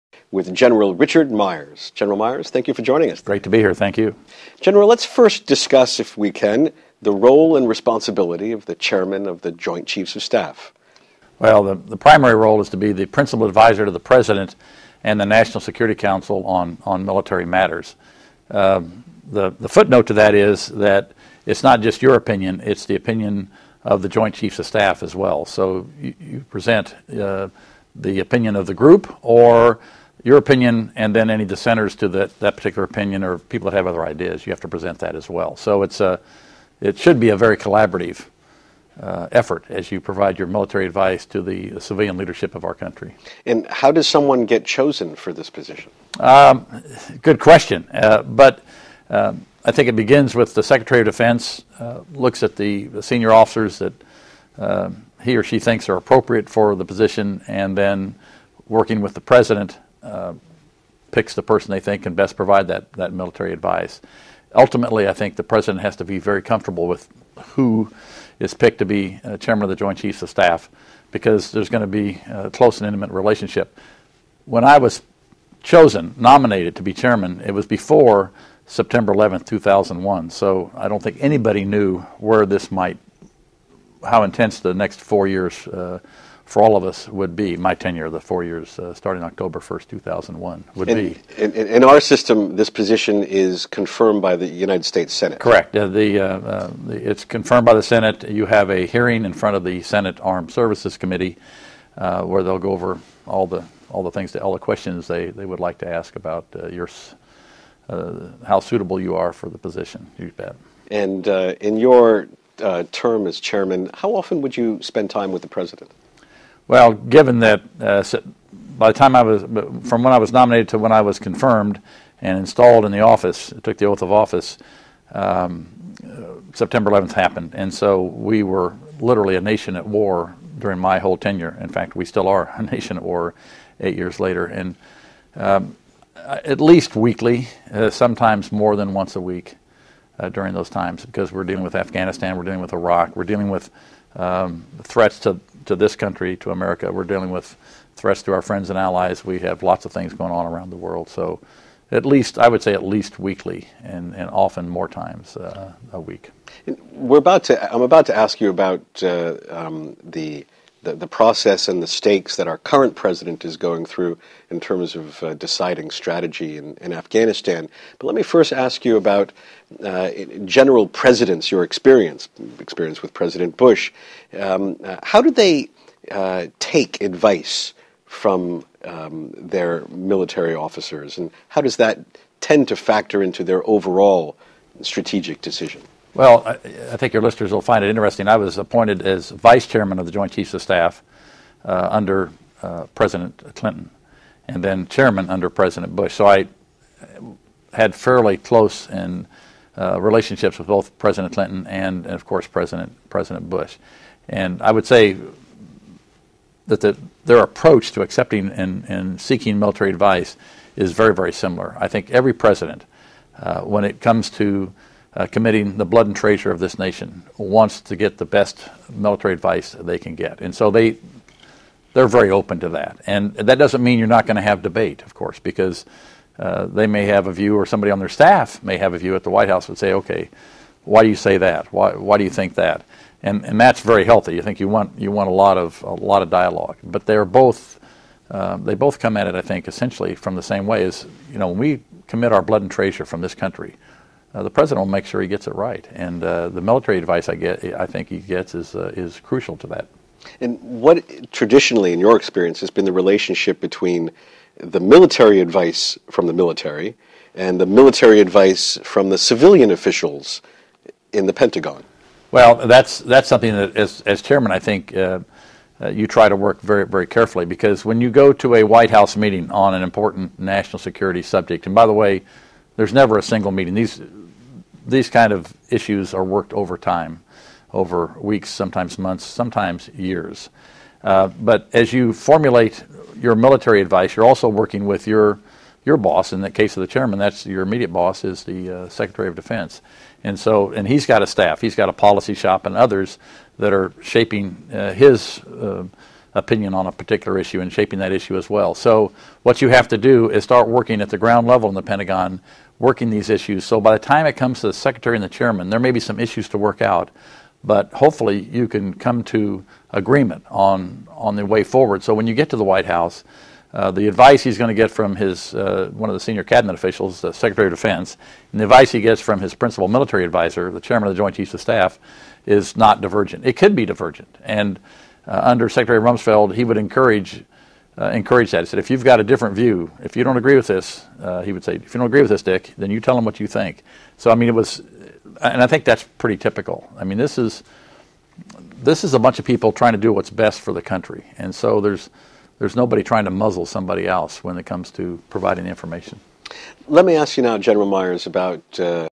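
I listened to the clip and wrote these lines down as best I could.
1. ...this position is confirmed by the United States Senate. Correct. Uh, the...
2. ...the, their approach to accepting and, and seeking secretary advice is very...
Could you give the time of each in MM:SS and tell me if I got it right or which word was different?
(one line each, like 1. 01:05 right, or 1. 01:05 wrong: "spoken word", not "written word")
1. 01:32 right
2. 03:26 wrong: "military", not "secretary".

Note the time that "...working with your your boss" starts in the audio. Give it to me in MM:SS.
04:44.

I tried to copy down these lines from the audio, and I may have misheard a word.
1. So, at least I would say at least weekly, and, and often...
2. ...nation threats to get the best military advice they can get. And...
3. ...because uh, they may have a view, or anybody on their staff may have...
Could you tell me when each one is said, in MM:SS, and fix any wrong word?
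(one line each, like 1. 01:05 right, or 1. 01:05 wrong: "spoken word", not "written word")
1. 02:31 right
2. 03:36 wrong: "wants", not "threats"
3. 03:45 wrong: "somebody", not "anybody".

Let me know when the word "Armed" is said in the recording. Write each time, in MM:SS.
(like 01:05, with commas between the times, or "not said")
01:40.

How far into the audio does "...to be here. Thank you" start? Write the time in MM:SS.
00:03.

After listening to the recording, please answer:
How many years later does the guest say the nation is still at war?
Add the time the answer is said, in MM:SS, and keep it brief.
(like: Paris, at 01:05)
8, at 02:13.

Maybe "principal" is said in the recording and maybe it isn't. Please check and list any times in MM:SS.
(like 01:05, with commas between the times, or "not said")
00:13, 05:19.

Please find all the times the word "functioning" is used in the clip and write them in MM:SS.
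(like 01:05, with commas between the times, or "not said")
not said.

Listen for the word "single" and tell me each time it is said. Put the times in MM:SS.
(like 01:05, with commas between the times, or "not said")
04:33.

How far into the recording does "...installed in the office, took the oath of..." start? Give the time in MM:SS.
02:02.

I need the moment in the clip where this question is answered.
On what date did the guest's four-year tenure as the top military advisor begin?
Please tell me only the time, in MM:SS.
01:29.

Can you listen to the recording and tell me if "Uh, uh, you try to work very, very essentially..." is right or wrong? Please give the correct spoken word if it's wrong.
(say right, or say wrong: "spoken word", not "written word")
wrong: "carefully", not "essentially".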